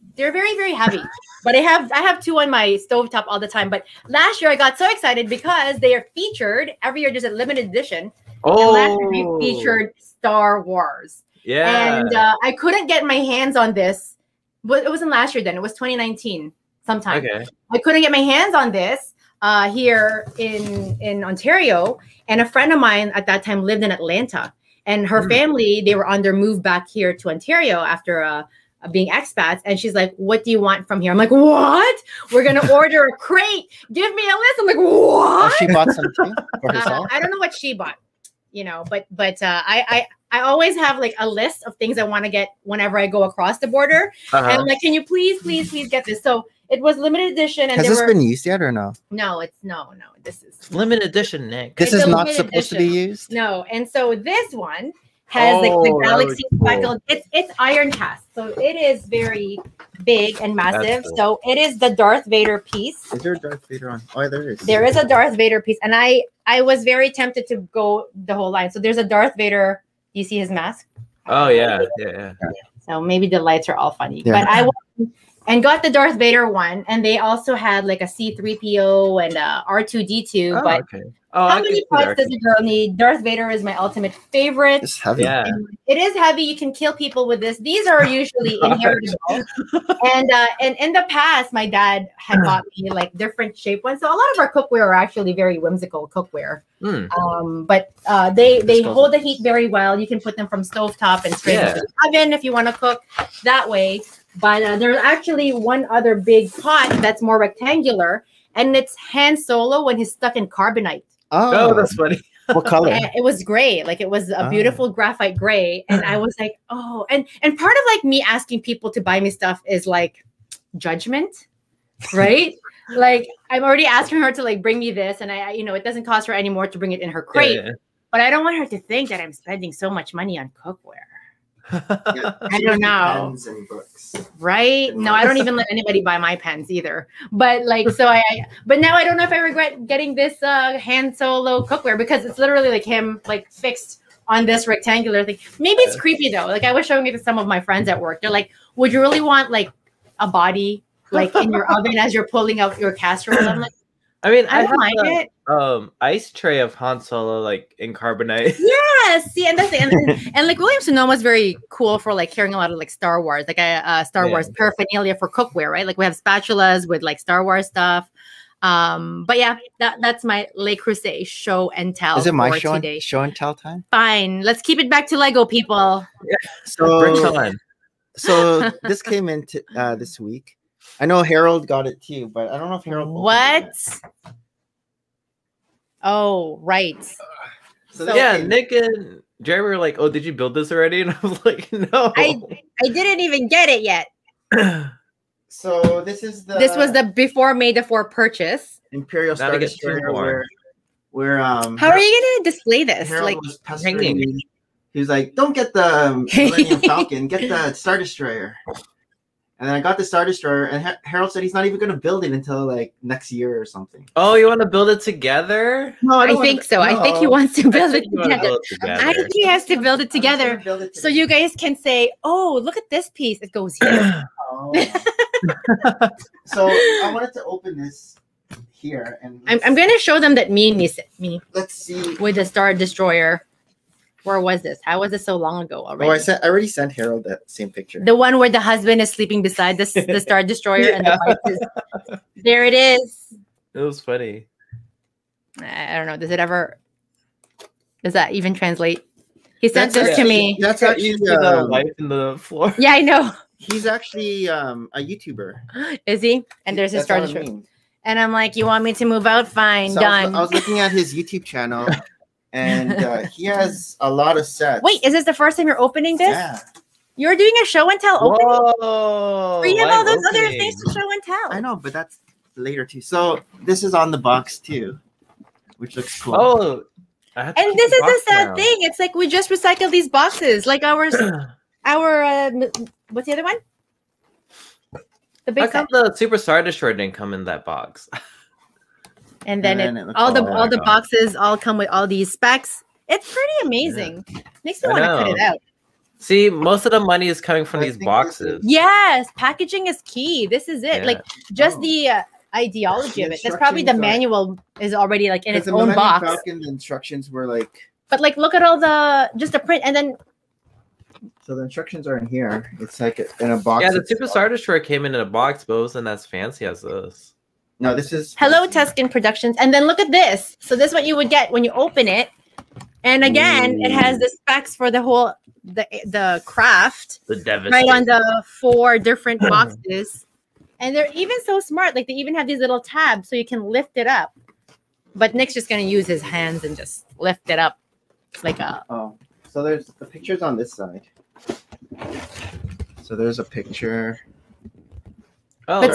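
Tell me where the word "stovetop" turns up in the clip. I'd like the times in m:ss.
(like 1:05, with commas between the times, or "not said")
0:02, 1:40.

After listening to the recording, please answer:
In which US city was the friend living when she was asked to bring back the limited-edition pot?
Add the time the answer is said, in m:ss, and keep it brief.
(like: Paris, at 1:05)
Atlanta, at 0:23.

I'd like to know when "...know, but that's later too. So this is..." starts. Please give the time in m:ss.
4:31.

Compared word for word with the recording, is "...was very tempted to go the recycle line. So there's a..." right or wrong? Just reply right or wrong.
wrong.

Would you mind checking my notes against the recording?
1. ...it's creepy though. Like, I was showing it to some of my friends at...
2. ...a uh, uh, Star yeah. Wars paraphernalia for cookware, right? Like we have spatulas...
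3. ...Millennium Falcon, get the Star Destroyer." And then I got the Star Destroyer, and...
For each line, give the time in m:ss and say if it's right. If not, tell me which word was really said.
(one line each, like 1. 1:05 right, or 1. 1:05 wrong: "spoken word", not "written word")
1. 2:25 right
2. 2:43 right
3. 3:26 right.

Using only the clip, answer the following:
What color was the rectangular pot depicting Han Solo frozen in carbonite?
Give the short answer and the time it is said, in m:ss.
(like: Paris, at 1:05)
graphite gray, at 1:54.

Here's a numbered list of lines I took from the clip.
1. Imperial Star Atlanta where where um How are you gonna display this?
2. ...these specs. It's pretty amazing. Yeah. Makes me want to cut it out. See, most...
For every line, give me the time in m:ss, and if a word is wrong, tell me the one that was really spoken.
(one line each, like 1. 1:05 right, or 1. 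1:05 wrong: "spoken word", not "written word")
1. 3:18 wrong: "Destroyer", not "Atlanta"
2. 4:52 right.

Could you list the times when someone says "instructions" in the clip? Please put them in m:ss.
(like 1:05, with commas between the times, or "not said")
5:06, 5:11.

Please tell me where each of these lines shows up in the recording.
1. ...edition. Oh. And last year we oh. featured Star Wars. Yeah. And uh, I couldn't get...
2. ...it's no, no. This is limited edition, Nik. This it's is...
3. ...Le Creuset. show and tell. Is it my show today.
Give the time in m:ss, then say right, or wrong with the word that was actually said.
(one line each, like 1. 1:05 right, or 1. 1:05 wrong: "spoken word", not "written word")
1. 0:07 right
2. 0:49 right
3. 2:50 right.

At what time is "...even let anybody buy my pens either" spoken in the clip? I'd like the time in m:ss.
2:15.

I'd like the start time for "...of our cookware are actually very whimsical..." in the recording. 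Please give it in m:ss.
1:34.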